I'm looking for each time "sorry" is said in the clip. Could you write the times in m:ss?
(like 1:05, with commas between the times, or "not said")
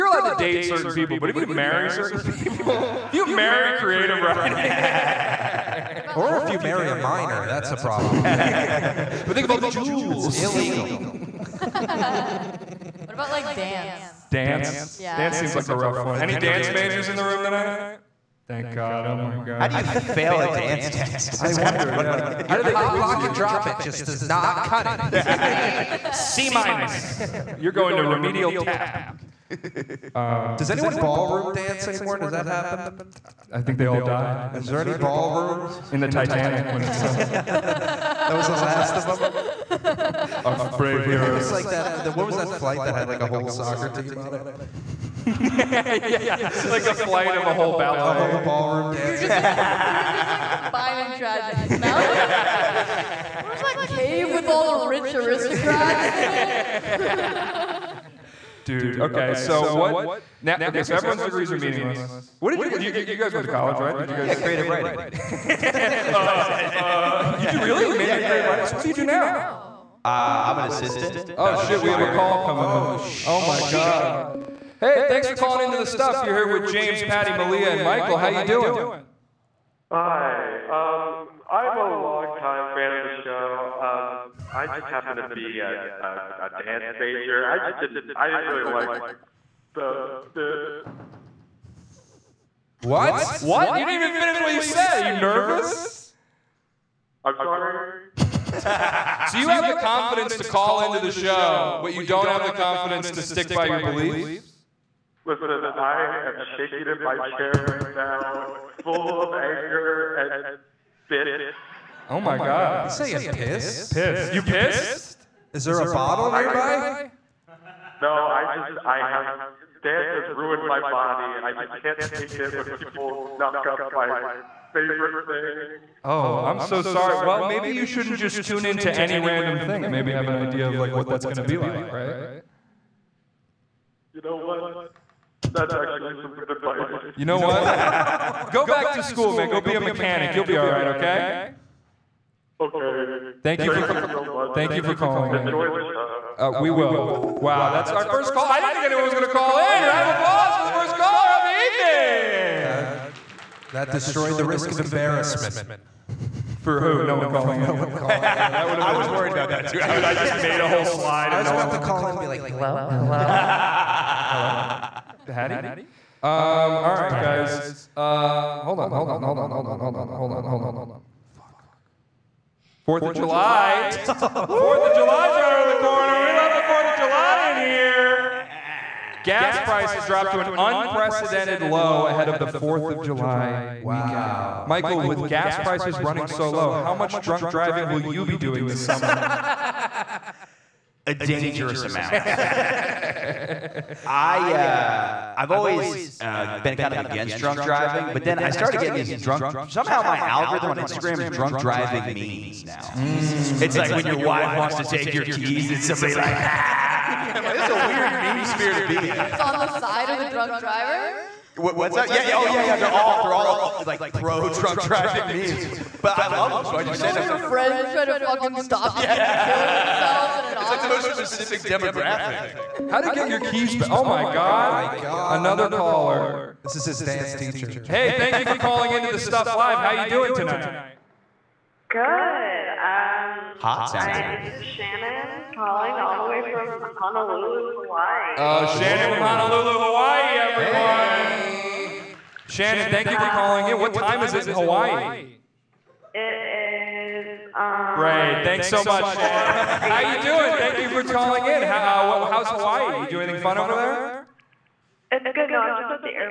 1:37, 2:06.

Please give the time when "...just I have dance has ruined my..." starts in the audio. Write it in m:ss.
1:58.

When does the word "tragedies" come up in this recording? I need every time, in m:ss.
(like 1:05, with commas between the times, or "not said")
0:51.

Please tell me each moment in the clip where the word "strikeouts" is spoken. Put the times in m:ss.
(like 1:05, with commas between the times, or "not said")
not said.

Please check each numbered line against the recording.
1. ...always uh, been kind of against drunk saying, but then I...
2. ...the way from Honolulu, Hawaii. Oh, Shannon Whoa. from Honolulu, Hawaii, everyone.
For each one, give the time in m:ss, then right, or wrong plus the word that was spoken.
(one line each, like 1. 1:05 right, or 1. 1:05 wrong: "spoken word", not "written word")
1. 3:15 wrong: "driving", not "saying"
2. 3:56 right.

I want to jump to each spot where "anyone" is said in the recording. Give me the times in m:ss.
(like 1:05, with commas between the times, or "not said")
0:30, 2:28.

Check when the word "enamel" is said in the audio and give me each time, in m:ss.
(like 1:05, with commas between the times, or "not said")
not said.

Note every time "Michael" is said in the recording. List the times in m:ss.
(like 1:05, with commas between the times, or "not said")
1:17, 3:04.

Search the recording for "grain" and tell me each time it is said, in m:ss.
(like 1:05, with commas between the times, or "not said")
not said.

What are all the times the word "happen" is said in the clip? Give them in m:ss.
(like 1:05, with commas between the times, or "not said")
0:32, 1:24.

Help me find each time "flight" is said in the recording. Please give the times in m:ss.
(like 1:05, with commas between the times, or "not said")
0:42, 0:46.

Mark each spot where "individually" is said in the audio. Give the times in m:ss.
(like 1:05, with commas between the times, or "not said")
not said.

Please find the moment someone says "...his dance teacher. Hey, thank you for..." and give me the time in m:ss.
3:46.